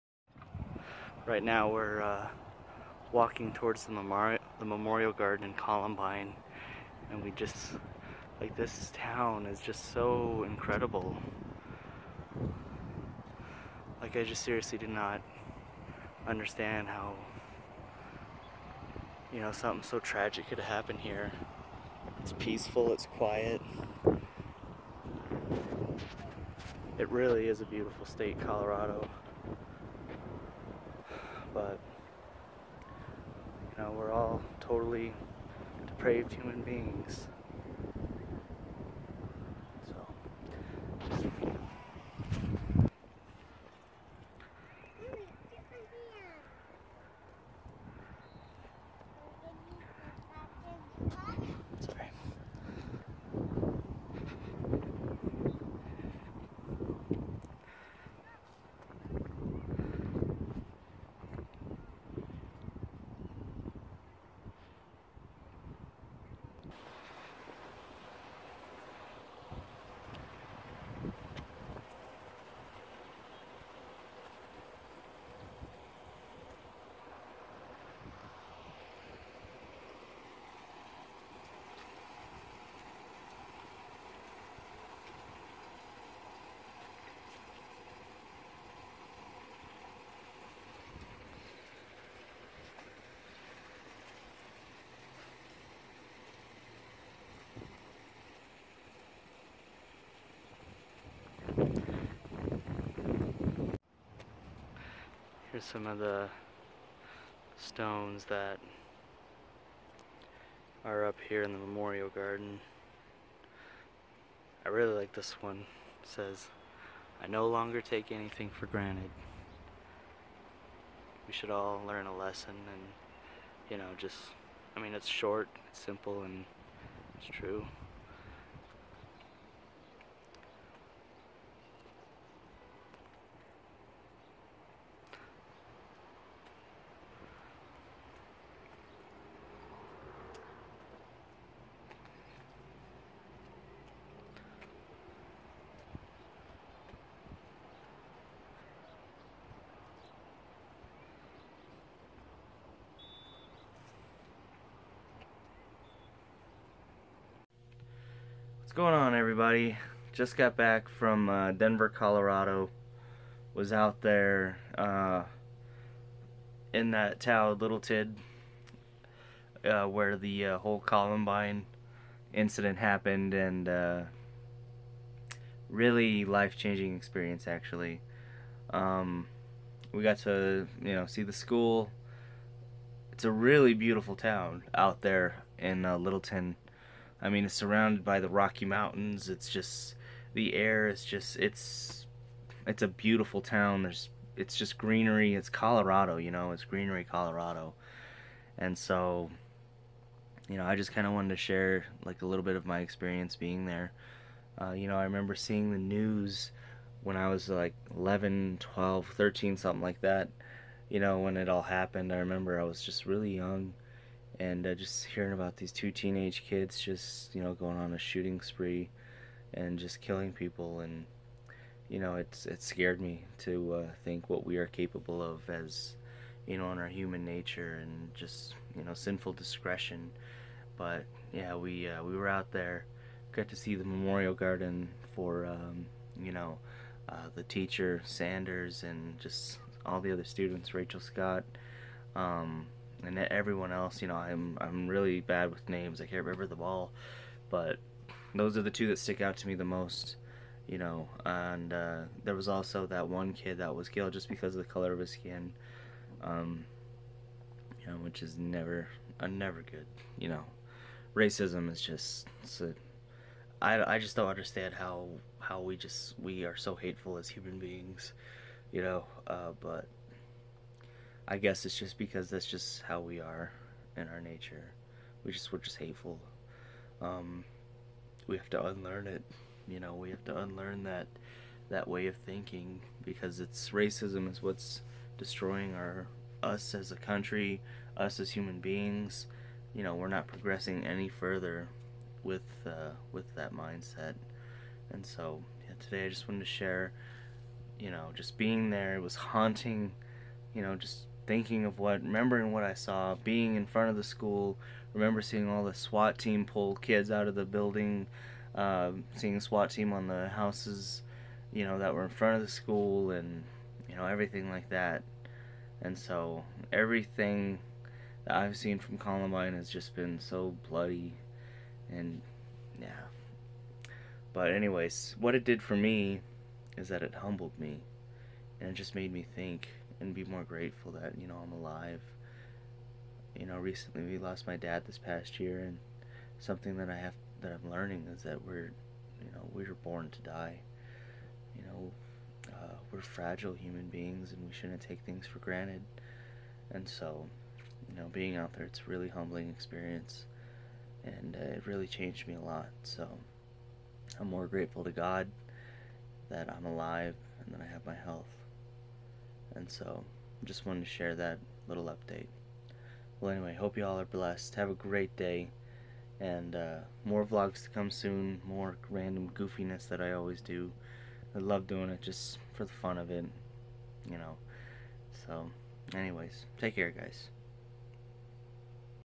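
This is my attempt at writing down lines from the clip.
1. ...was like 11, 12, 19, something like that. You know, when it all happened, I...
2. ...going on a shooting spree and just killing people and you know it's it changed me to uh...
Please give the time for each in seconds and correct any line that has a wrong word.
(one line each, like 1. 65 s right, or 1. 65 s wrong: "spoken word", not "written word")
1. 207 s wrong: "13", not "19"
2. 217 s wrong: "scared", not "changed".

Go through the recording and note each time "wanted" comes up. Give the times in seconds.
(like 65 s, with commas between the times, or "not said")
201 s, 296 s, 360 s.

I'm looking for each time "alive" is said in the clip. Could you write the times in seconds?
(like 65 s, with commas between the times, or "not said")
331 s, 356 s.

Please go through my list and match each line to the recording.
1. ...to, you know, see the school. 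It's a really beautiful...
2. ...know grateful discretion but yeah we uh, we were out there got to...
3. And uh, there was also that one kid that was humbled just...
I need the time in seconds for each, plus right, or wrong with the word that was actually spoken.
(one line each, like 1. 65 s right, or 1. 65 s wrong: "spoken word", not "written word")
1. 180 s right
2. 228 s wrong: "sinful", not "grateful"
3. 251 s wrong: "killed", not "humbled".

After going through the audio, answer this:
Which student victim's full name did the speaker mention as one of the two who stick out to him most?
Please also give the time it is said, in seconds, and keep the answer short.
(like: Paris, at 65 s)
Rachel Scott, at 240 s.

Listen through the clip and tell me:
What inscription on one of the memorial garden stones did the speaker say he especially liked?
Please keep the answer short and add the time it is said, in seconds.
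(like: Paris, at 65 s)
I no longer take anything for granted, at 117 s.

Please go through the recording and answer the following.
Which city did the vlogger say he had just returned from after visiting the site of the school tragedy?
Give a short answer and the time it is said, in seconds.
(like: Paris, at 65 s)
Denver, at 161 s.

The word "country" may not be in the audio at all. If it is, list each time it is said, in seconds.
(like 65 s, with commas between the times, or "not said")
286 s.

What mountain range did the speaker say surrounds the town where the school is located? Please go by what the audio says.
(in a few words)
Rocky Mountains.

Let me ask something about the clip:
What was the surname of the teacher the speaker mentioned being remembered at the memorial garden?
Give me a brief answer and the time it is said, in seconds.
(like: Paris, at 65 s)
Sanders, at 238 s.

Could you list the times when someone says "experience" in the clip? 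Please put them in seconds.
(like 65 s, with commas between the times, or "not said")
176 s, 202 s, 349 s.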